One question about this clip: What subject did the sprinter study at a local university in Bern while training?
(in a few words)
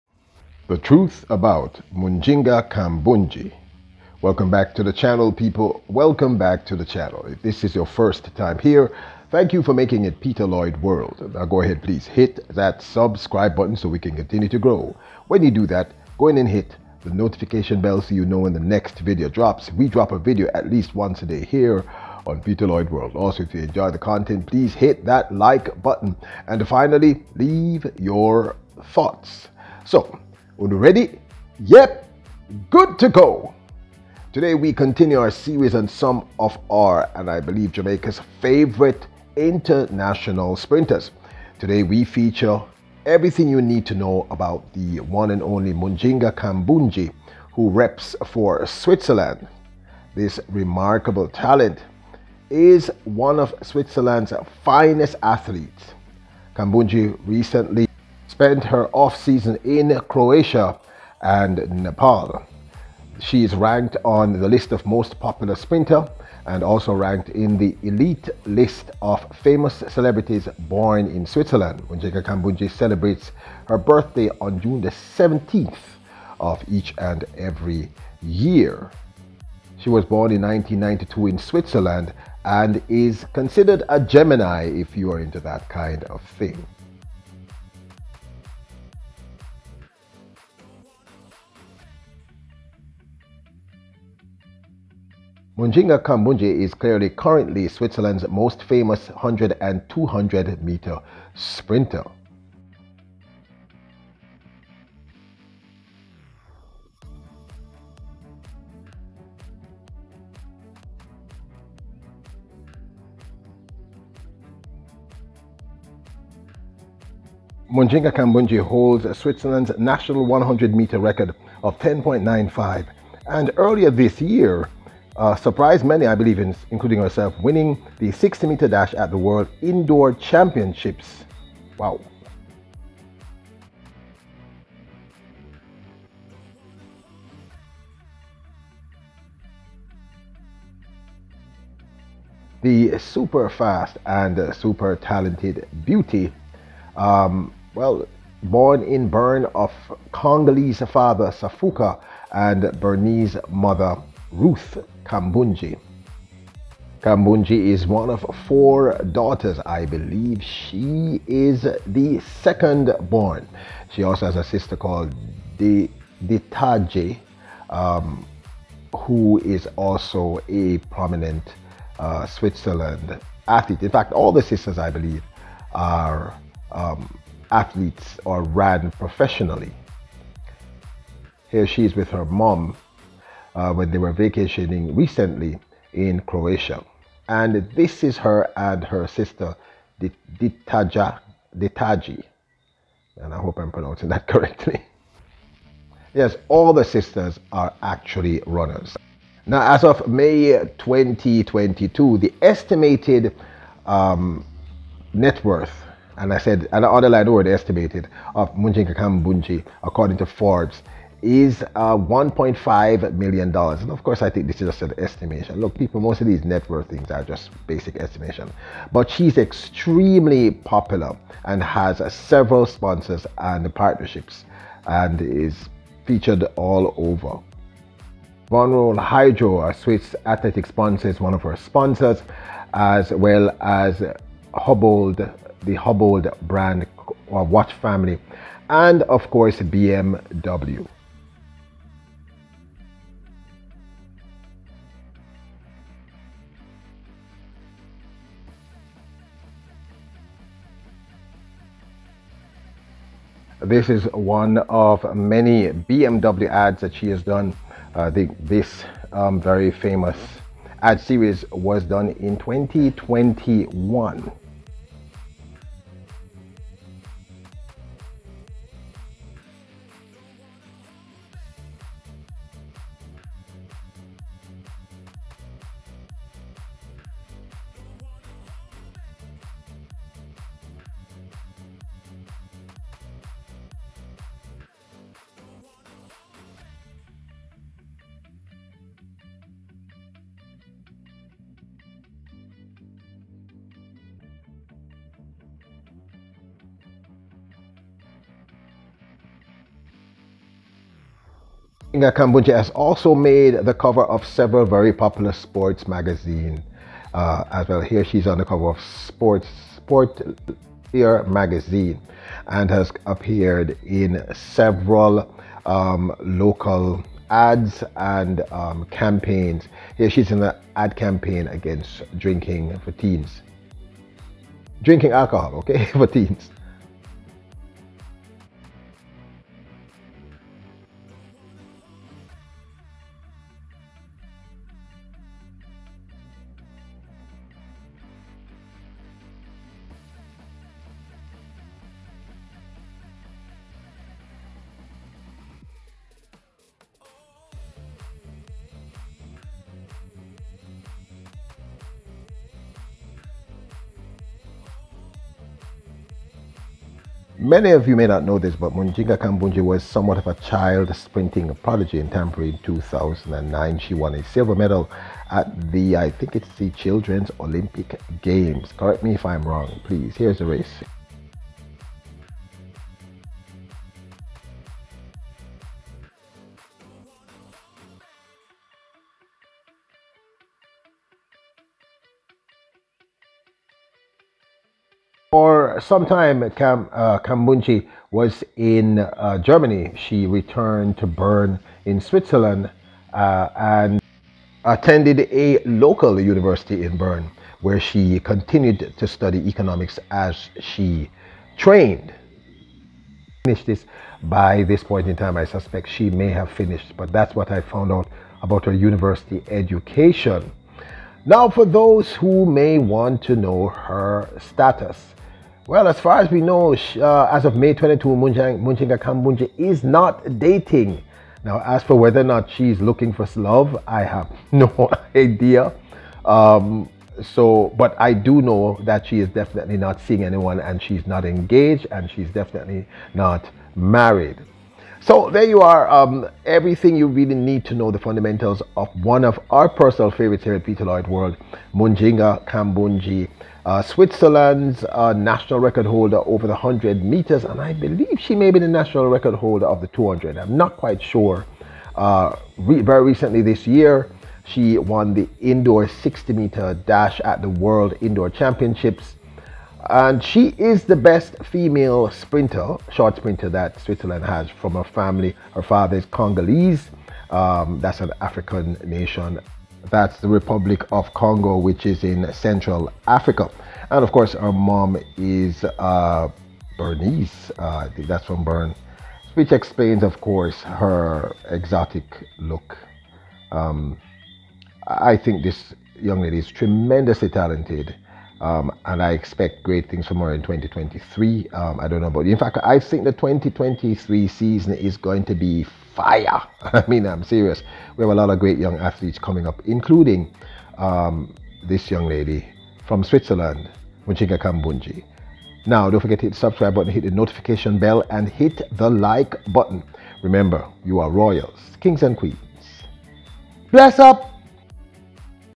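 Economics.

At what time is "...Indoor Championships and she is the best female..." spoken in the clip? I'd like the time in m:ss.
7:38.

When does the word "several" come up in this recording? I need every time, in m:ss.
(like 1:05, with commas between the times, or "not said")
3:42, 5:04, 5:14.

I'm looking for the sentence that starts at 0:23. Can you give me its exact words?
Also, if you enjoy the content, please hit that like button.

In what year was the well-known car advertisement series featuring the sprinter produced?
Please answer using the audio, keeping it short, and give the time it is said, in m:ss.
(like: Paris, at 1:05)
2021, at 4:22.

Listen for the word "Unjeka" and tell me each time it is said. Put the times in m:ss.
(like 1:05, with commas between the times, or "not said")
1:11.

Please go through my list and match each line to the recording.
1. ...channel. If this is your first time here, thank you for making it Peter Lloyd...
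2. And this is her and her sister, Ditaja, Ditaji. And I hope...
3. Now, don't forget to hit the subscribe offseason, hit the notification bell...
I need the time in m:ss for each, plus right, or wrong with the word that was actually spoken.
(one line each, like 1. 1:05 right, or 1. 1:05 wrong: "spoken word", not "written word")
1. 0:06 right
2. 3:07 right
3. 8:25 wrong: "button", not "offseason".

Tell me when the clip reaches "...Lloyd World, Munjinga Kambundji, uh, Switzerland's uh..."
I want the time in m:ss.
7:20.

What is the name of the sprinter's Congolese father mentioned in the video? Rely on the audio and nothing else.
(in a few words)
Safuka.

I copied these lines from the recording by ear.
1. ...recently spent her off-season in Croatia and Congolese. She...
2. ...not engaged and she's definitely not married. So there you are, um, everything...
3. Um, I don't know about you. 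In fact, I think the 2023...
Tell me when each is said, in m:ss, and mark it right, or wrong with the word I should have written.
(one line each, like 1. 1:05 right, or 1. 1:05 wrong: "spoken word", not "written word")
1. 0:57 wrong: "Nepal", not "Congolese"
2. 7:11 right
3. 8:11 right.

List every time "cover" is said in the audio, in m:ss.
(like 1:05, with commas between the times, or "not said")
5:03, 5:08.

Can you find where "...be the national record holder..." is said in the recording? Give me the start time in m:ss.
7:28.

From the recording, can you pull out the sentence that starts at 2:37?
Kambundji is one of four daughters.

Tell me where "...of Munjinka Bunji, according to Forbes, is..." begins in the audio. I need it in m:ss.
3:28.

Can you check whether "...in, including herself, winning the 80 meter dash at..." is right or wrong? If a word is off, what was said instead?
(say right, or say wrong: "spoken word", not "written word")
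wrong: "60", not "80".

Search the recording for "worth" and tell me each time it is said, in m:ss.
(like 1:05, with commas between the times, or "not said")
3:25, 3:36.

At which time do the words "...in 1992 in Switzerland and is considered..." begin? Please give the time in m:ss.
1:20.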